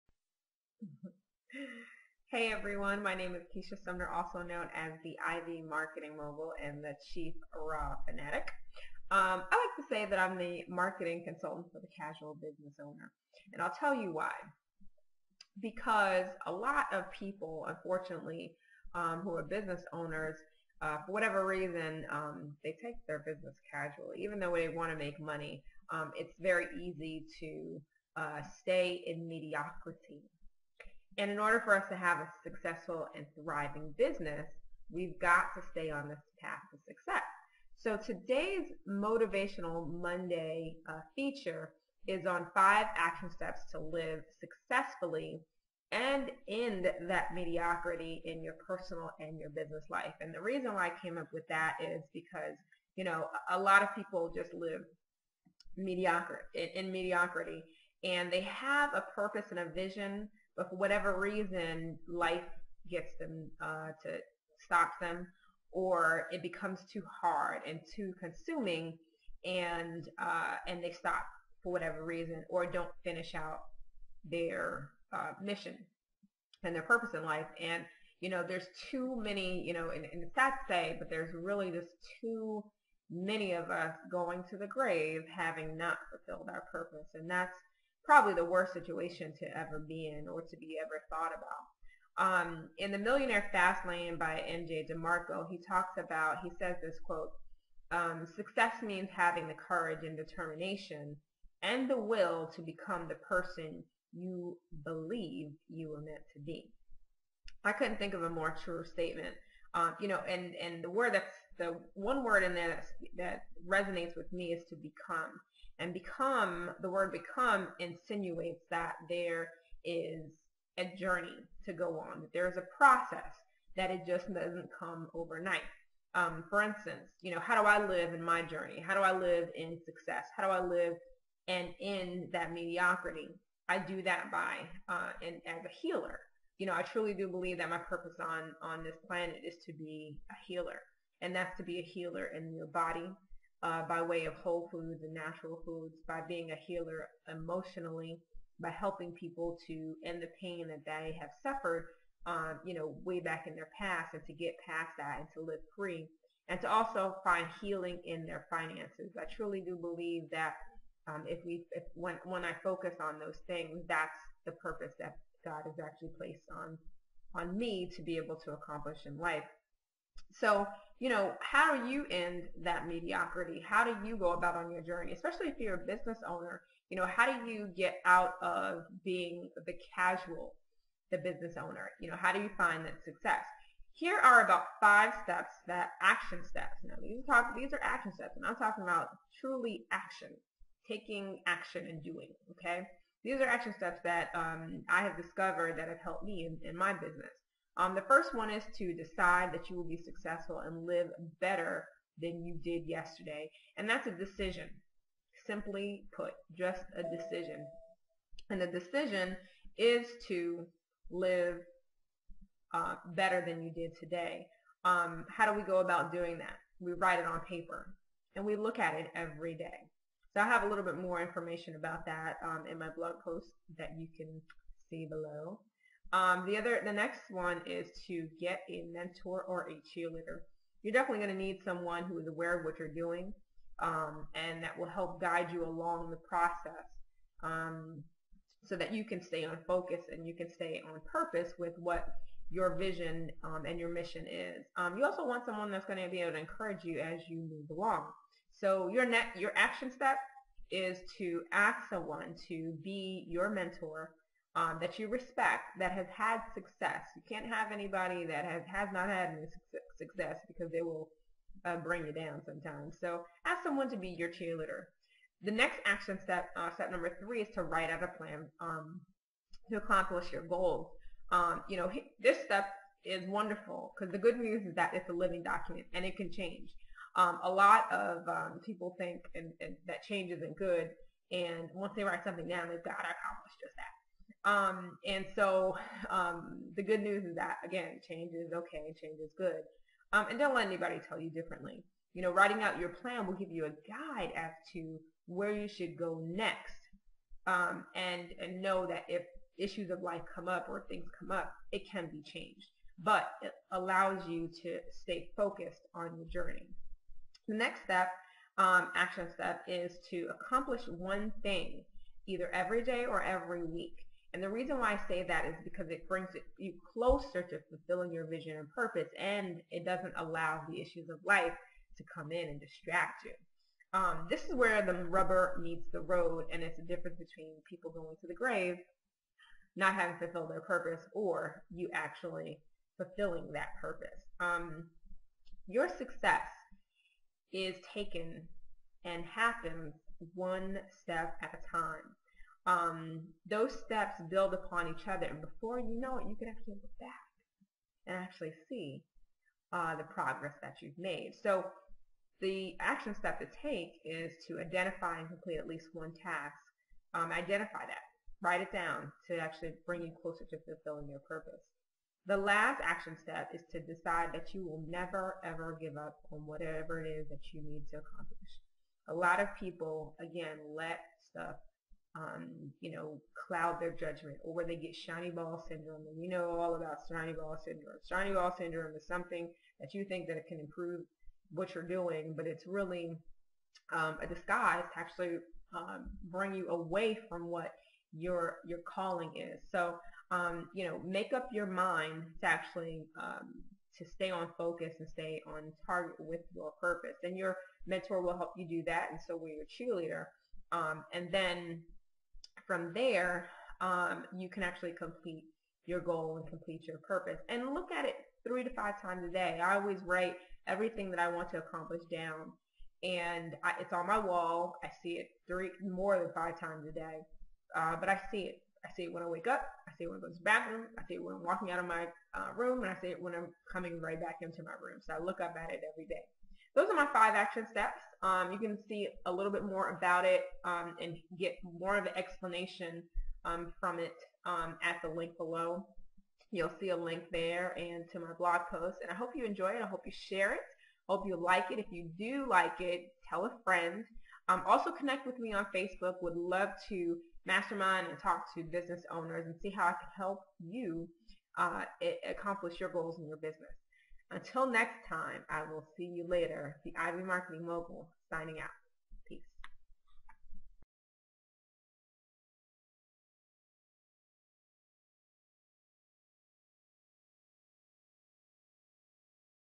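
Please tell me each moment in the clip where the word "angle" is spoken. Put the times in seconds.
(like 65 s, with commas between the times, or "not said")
not said.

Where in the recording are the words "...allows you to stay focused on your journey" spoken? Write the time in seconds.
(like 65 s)
303 s.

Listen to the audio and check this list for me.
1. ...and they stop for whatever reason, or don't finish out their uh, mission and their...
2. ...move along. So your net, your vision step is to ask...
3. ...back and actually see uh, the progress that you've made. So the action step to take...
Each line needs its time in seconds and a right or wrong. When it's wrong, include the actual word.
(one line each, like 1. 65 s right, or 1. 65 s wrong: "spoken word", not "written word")
1. 70 s right
2. 247 s wrong: "action", not "vision"
3. 346 s right.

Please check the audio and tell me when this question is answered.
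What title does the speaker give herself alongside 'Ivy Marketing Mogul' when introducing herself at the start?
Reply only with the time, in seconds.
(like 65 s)
7 s.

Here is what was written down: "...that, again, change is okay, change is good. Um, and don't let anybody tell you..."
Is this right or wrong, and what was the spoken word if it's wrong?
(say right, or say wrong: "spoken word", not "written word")
right.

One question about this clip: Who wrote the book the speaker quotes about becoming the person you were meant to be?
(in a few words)
MJ DeMarco.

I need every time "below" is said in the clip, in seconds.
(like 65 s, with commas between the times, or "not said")
225 s, 435 s.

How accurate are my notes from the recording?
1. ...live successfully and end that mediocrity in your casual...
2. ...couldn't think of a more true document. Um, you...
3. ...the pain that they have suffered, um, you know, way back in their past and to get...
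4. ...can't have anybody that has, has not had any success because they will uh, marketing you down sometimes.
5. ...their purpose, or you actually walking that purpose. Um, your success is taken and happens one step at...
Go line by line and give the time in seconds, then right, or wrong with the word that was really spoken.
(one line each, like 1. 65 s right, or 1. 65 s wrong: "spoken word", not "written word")
1. 43 s wrong: "personal", not "casual"
2. 107 s wrong: "statement", not "document"
3. 150 s right
4. 257 s wrong: "bring", not "marketing"
5. 330 s wrong: "fulfilling", not "walking".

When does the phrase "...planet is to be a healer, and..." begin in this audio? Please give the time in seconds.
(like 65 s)
139 s.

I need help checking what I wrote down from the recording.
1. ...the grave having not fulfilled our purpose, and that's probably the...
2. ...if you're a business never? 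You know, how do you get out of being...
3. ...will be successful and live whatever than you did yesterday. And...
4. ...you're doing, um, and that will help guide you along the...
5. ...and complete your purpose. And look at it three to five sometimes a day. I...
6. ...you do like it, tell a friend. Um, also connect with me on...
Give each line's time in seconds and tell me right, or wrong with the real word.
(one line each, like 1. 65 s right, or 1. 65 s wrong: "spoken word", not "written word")
1. 84 s right
2. 175 s wrong: "owner", not "never"
3. 199 s wrong: "better", not "whatever"
4. 232 s right
5. 406 s wrong: "times", not "sometimes"
6. 441 s right.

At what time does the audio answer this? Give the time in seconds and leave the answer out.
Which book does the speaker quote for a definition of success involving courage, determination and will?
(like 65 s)
92 s.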